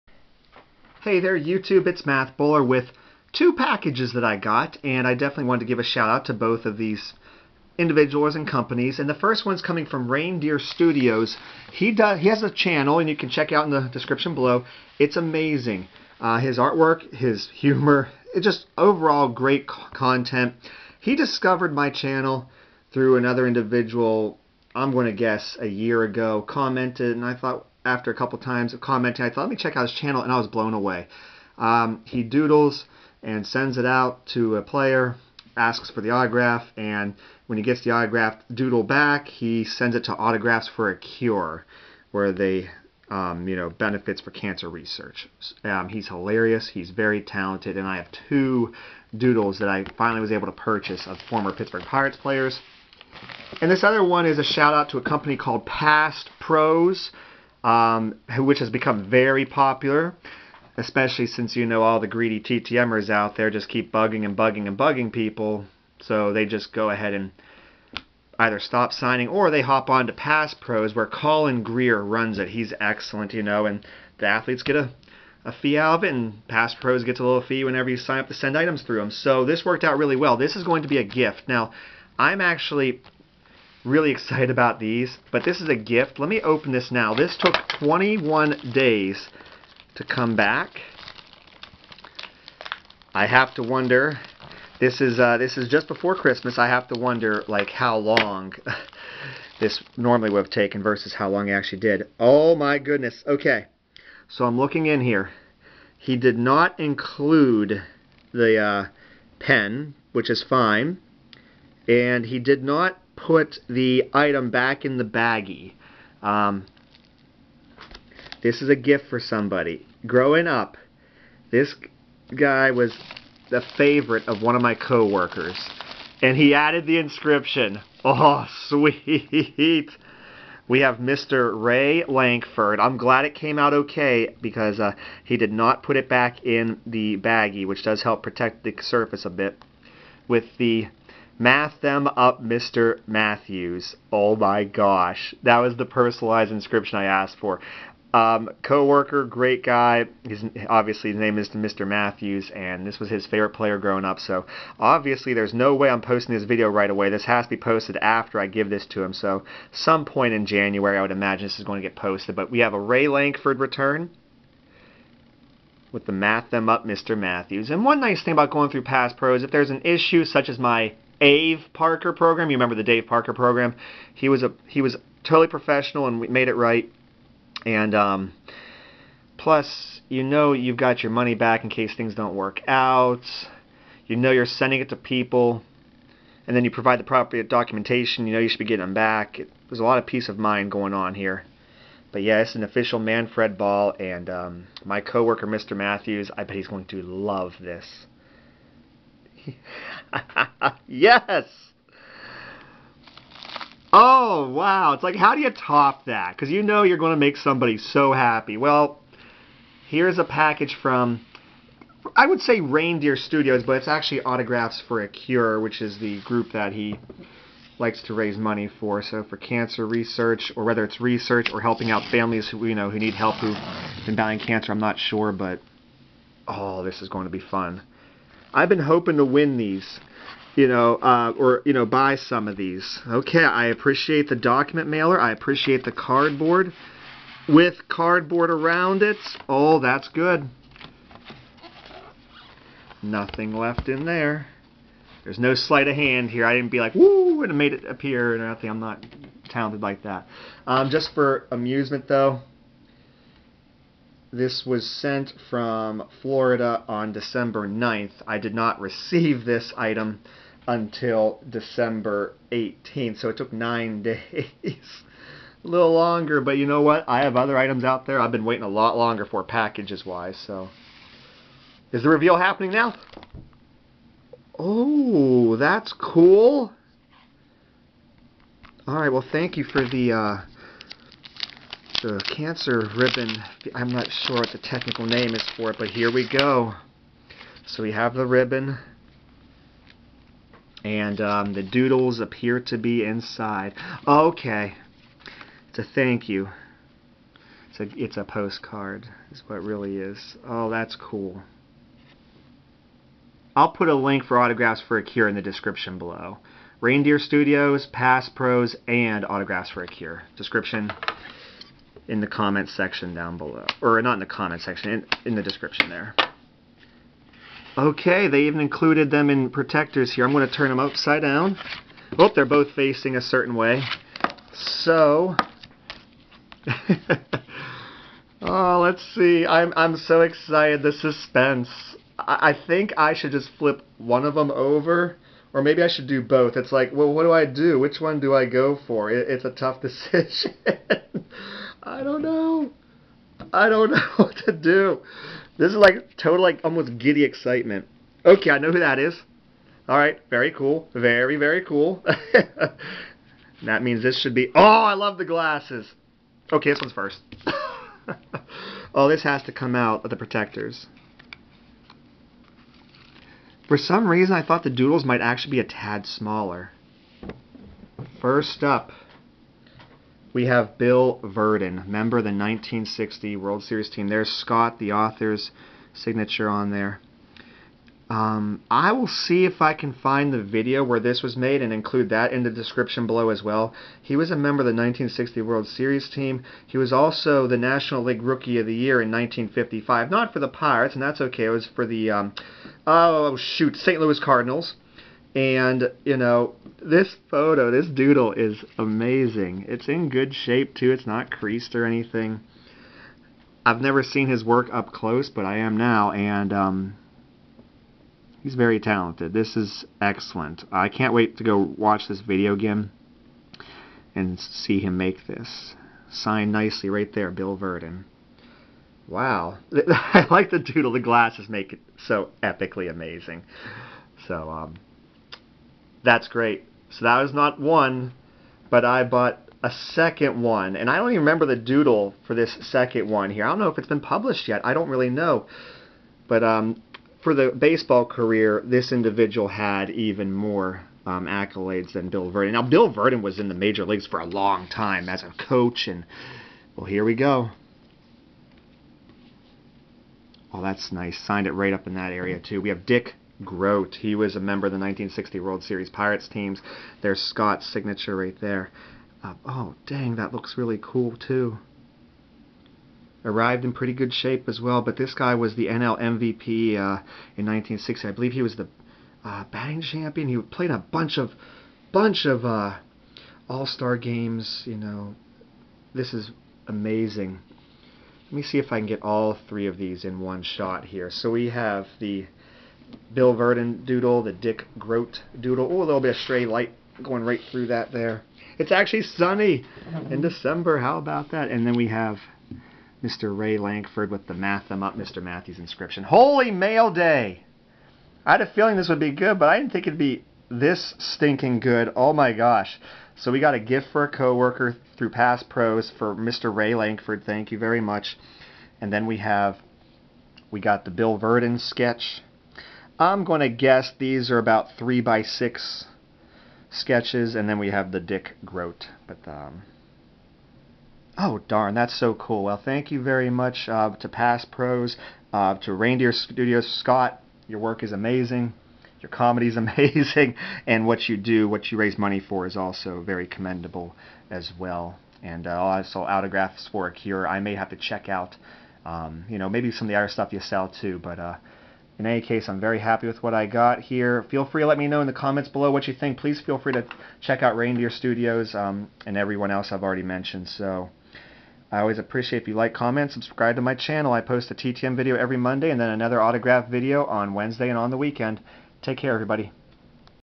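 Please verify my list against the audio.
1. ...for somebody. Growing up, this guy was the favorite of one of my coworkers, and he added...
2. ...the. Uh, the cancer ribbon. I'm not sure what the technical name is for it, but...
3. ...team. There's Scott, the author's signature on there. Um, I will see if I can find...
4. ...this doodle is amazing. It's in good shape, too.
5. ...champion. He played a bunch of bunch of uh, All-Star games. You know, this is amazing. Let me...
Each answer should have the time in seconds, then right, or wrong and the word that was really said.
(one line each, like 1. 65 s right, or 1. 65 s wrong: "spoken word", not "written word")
1. 119 s right
2. 279 s right
3. 373 s right
4. 397 s right
5. 469 s right.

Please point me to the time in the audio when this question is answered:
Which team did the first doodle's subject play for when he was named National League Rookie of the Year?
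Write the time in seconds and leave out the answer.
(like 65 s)
393 s.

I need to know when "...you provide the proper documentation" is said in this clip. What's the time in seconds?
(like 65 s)
186 s.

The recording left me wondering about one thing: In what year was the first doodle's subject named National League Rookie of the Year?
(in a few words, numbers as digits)
1955.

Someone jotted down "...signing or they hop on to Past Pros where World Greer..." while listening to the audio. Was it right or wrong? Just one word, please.
wrong.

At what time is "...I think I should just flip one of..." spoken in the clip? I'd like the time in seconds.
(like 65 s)
332 s.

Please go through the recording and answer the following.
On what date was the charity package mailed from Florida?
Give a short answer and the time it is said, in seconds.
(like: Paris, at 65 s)
December 9th, at 257 s.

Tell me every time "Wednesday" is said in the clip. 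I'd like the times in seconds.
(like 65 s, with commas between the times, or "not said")
557 s.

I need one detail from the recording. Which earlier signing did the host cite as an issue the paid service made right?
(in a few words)
Dave Parker.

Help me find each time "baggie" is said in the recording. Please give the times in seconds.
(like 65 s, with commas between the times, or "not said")
115 s, 137 s.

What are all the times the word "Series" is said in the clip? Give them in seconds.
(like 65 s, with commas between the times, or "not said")
373 s, 385 s, 455 s.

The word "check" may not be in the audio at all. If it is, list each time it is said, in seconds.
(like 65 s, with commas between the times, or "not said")
13 s, 29 s, 537 s, 547 s.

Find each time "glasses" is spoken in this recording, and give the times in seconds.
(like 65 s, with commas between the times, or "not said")
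355 s, 420 s.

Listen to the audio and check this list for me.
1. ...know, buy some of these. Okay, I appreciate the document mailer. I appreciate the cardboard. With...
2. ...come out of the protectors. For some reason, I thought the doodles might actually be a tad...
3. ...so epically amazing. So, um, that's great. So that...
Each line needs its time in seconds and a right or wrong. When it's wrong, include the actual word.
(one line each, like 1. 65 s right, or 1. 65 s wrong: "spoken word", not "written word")
1. 231 s right
2. 359 s right
3. 421 s right.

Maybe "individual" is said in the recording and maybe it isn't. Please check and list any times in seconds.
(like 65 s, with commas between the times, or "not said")
7 s, 23 s, 438 s.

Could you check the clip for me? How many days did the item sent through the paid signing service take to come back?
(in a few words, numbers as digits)
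21.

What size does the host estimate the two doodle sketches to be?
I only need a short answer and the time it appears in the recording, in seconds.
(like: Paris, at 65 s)
3 by 6, at 514 s.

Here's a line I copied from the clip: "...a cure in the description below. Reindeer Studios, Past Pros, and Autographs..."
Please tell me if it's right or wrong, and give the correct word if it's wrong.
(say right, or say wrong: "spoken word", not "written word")
right.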